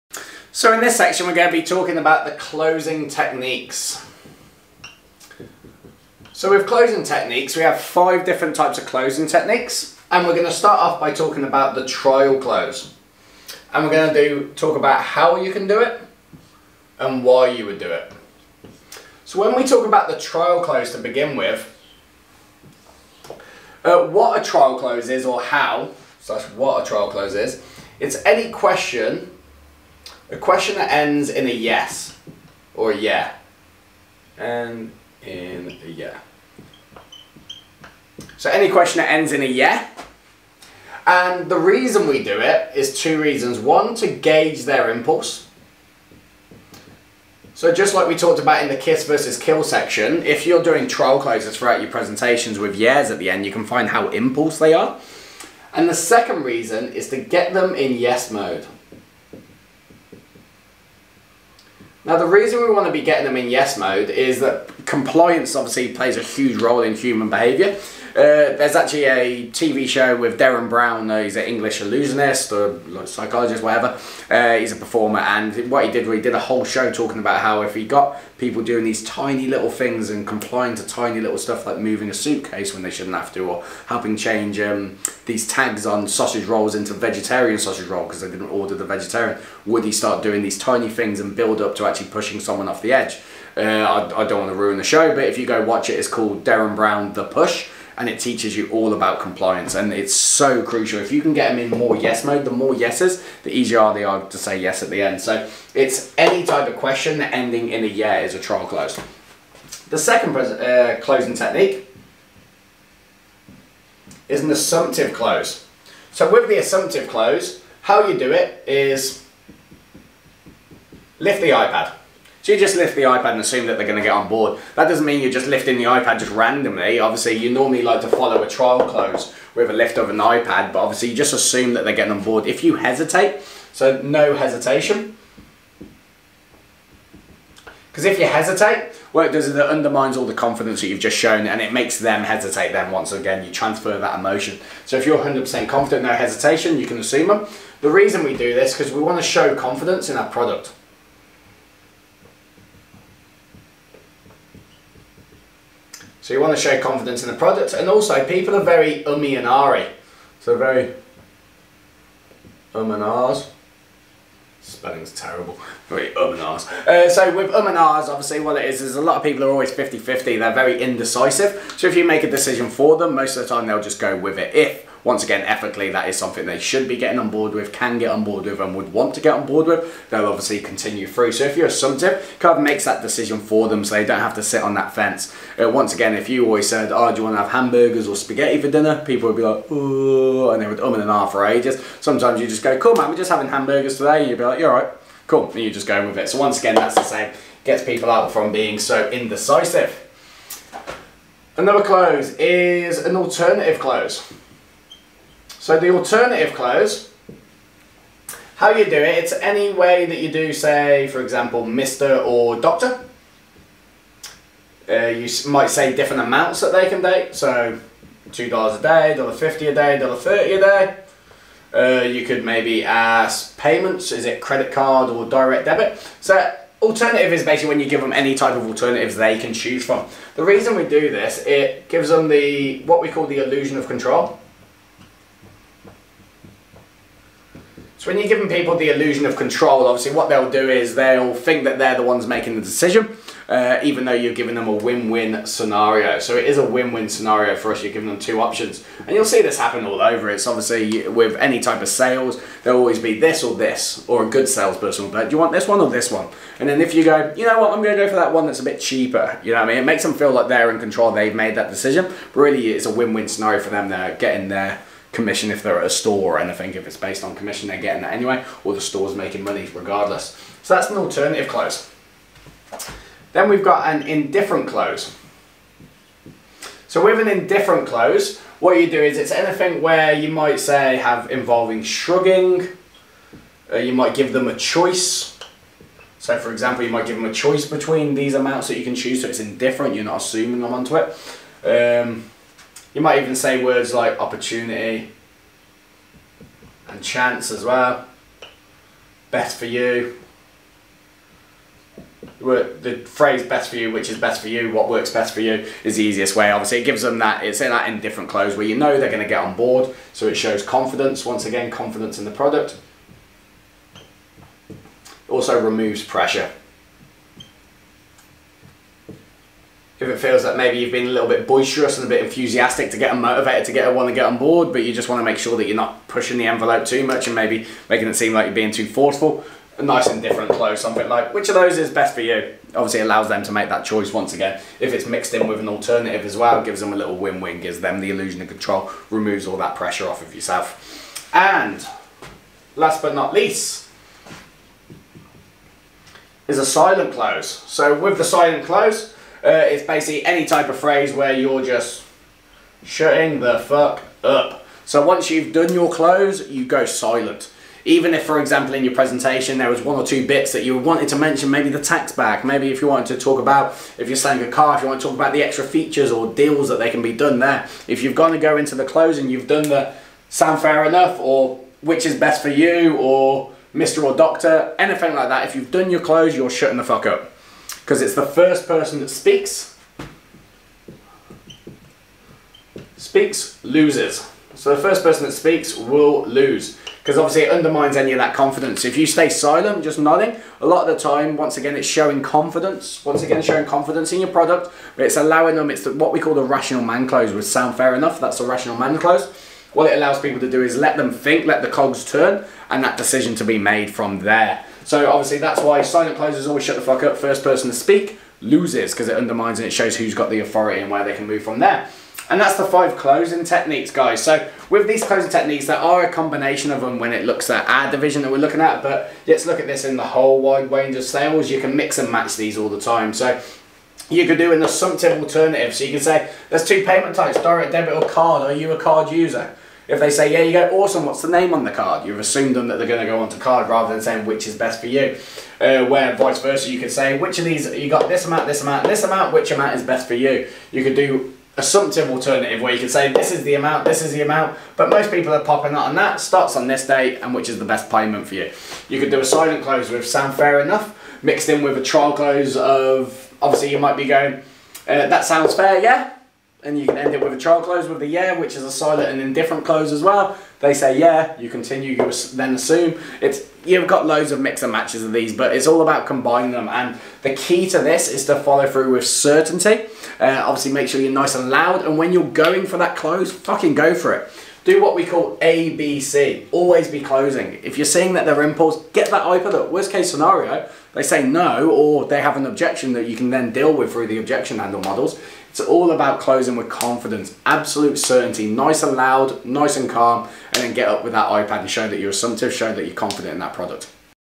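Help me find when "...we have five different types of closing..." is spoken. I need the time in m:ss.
0:07.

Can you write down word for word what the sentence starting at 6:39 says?
What it allows people to do is let them think, let the cogs turn, and that decision to be made from there.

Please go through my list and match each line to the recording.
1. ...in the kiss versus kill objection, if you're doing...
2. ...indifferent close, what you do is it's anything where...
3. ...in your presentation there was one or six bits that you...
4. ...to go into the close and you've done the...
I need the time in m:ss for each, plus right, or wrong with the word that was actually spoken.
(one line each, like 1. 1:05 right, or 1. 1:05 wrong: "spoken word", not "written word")
1. 0:48 wrong: "section", not "objection"
2. 4:37 right
3. 5:58 wrong: "two", not "six"
4. 6:08 right.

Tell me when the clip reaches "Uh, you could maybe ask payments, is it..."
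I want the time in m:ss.
3:41.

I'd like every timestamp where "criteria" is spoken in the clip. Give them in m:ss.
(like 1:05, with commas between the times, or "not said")
not said.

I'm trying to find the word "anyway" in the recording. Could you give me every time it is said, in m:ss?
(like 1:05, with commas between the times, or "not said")
4:28.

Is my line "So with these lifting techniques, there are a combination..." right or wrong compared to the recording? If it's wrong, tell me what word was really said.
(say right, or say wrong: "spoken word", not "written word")
wrong: "closing", not "lifting".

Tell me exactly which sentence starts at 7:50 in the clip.
Uh, obviously, make sure you're nice and loud.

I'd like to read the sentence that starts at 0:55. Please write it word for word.
And the second reason is to get them in yes mode.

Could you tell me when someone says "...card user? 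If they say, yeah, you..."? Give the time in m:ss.
7:08.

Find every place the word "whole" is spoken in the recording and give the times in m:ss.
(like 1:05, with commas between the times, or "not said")
1:16, 7:00.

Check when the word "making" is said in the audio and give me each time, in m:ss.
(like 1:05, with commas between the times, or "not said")
4:02, 4:29, 5:27.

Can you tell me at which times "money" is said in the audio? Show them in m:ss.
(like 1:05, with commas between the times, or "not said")
4:29.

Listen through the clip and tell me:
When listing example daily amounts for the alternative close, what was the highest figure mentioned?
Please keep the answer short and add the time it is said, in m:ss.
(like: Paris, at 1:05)
$2 a day, at 3:38.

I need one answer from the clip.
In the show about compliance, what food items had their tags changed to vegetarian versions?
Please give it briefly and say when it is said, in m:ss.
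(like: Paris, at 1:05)
Sausage rolls, at 1:26.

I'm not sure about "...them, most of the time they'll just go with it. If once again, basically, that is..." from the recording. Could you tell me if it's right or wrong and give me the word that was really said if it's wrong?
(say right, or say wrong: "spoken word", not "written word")
wrong: "ethically", not "basically".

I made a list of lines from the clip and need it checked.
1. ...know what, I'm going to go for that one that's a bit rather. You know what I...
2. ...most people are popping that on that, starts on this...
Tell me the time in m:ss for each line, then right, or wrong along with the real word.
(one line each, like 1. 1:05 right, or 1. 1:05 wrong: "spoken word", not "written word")
1. 4:17 wrong: "cheaper", not "rather"
2. 7:24 right.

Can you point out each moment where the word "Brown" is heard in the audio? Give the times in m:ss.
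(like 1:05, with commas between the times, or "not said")
1:10, 1:36.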